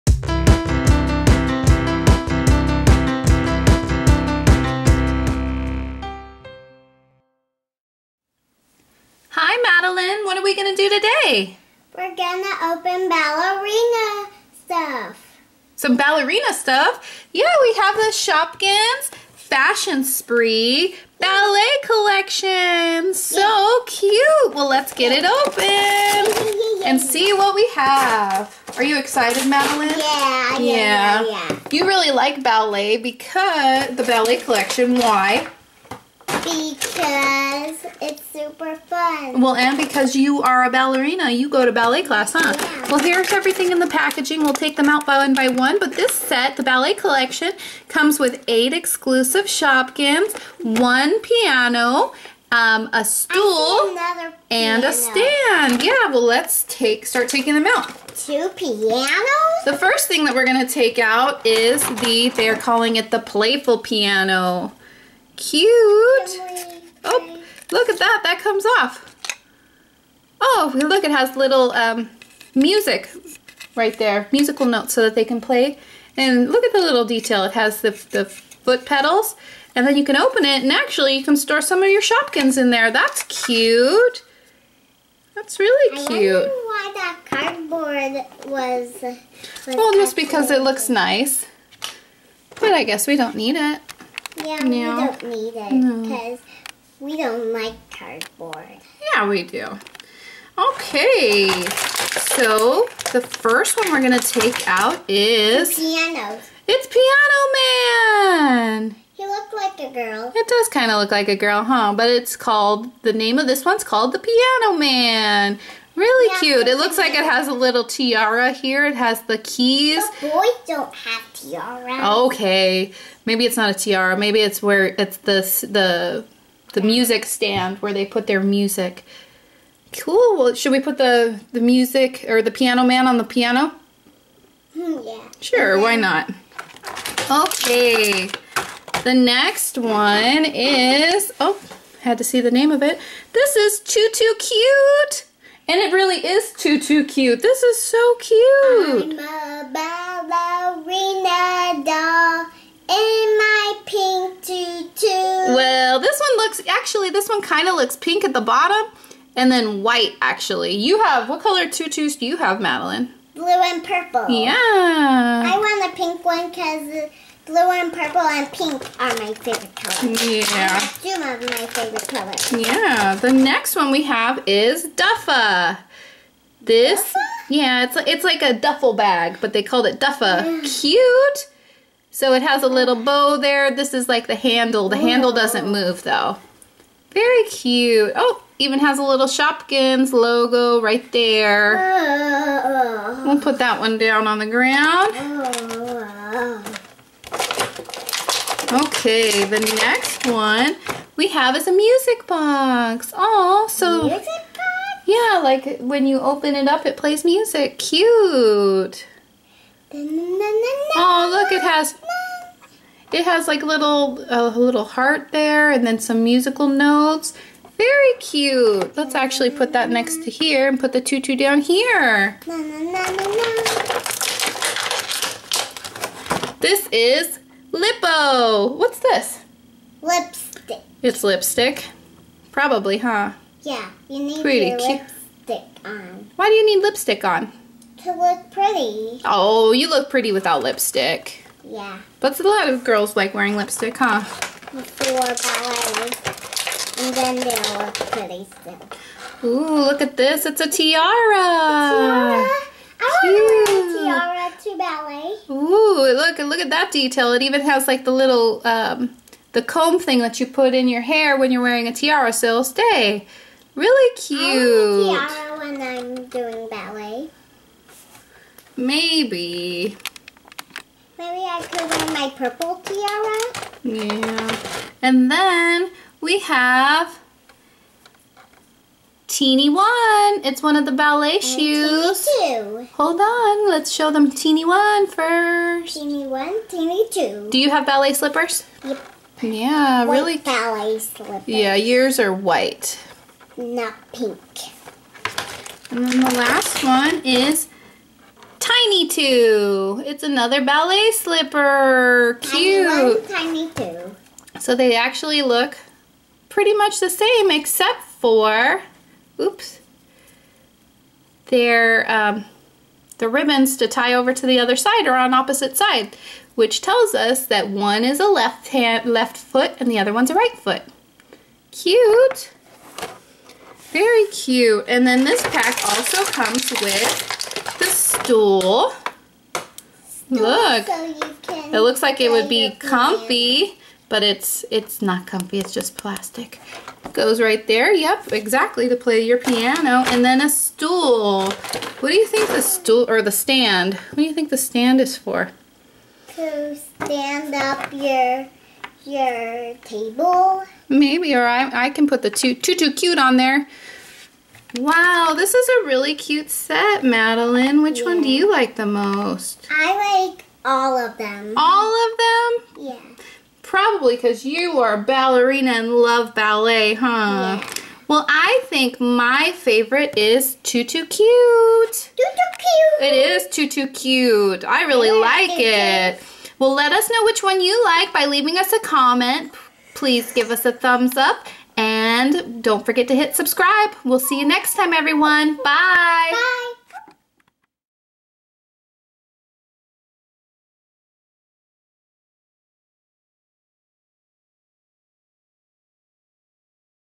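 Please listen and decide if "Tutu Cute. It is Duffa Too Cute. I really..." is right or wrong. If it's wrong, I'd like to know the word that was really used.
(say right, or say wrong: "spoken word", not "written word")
wrong: "Too", not "Duffa".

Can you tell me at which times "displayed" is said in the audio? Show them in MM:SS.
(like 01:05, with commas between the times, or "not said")
not said.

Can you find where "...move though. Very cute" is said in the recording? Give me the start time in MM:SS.
03:05.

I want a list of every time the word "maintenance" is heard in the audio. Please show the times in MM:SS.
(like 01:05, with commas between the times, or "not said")
not said.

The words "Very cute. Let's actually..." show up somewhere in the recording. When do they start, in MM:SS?
03:37.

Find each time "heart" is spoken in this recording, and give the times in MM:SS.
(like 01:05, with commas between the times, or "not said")
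03:34.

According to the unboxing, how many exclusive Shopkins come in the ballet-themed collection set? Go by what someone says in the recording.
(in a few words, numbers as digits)
8.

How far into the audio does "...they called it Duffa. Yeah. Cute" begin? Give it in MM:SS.
02:59.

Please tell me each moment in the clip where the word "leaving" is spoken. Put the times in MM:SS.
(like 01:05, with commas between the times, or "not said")
06:18.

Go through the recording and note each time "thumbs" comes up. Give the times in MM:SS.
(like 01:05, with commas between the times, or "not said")
06:20.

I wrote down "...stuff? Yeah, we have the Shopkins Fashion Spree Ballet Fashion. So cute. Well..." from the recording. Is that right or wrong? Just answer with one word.
wrong.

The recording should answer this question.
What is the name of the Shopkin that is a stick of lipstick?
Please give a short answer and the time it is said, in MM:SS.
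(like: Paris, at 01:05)
Lippo, at 03:47.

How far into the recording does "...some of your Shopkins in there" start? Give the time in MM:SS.
01:21.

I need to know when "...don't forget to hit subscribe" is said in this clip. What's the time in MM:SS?
06:22.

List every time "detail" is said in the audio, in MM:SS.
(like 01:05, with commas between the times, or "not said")
01:17, 04:16.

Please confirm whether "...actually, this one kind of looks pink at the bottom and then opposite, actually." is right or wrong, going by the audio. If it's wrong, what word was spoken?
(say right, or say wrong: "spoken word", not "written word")
wrong: "white", not "opposite".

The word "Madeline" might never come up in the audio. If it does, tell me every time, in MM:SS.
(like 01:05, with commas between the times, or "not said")
00:29, 02:42, 05:57.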